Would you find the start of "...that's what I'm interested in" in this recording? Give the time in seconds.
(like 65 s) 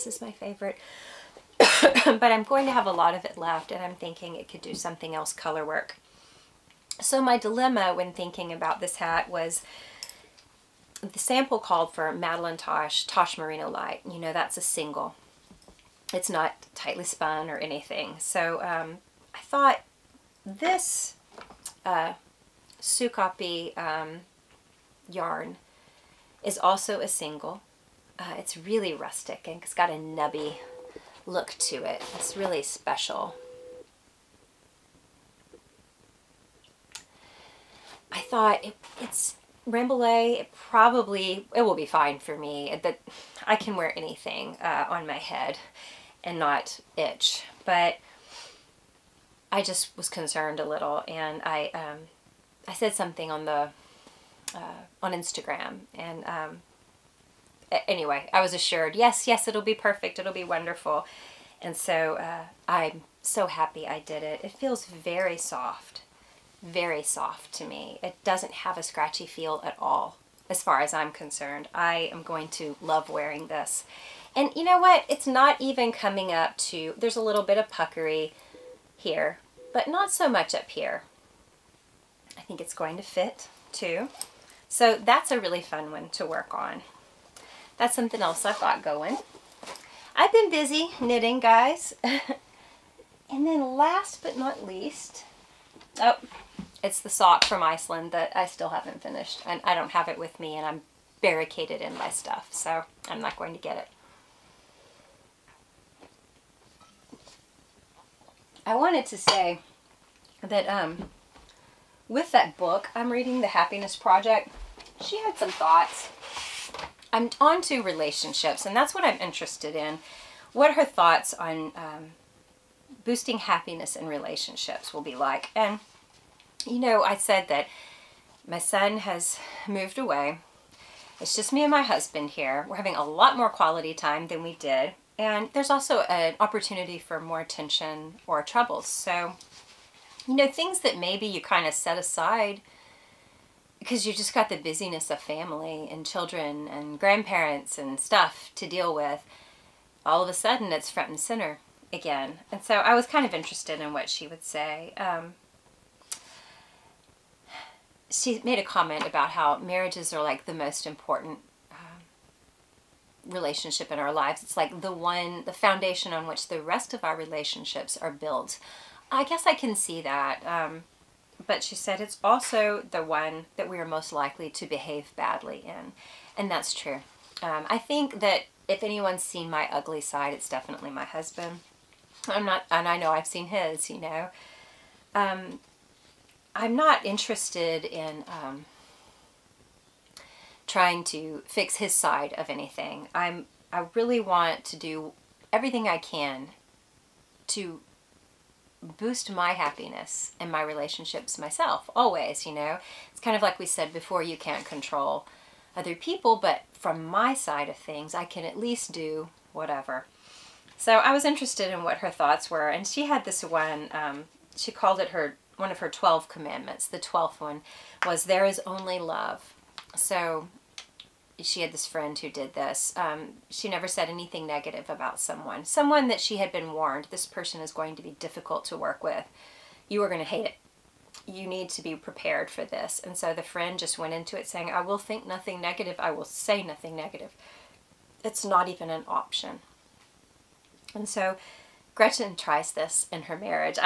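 118 s.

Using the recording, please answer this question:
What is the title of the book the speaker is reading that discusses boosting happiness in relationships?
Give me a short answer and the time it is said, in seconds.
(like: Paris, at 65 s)
The Happiness Project, at 113 s.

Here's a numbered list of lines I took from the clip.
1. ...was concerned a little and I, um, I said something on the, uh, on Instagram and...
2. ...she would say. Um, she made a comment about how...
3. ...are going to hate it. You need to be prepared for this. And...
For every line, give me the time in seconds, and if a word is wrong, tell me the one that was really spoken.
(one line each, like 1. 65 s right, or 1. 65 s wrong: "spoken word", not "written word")
1. 49 s right
2. 154 s right
3. 230 s right.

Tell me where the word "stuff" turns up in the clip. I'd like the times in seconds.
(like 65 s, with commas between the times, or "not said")
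102 s, 147 s.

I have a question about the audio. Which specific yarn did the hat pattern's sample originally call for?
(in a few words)
Tosh Merino Light.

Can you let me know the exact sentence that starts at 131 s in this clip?
It's just me and my husband here.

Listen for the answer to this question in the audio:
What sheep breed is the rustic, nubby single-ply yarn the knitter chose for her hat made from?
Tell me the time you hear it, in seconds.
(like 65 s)
39 s.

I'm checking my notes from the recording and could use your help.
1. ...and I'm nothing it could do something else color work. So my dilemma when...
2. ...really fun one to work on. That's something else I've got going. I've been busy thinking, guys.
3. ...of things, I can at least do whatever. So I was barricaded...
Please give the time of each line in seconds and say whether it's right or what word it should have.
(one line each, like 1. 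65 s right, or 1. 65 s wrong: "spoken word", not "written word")
1. 3 s wrong: "thinking", not "nothing"
2. 85 s wrong: "knitting", not "thinking"
3. 207 s wrong: "interested", not "barricaded".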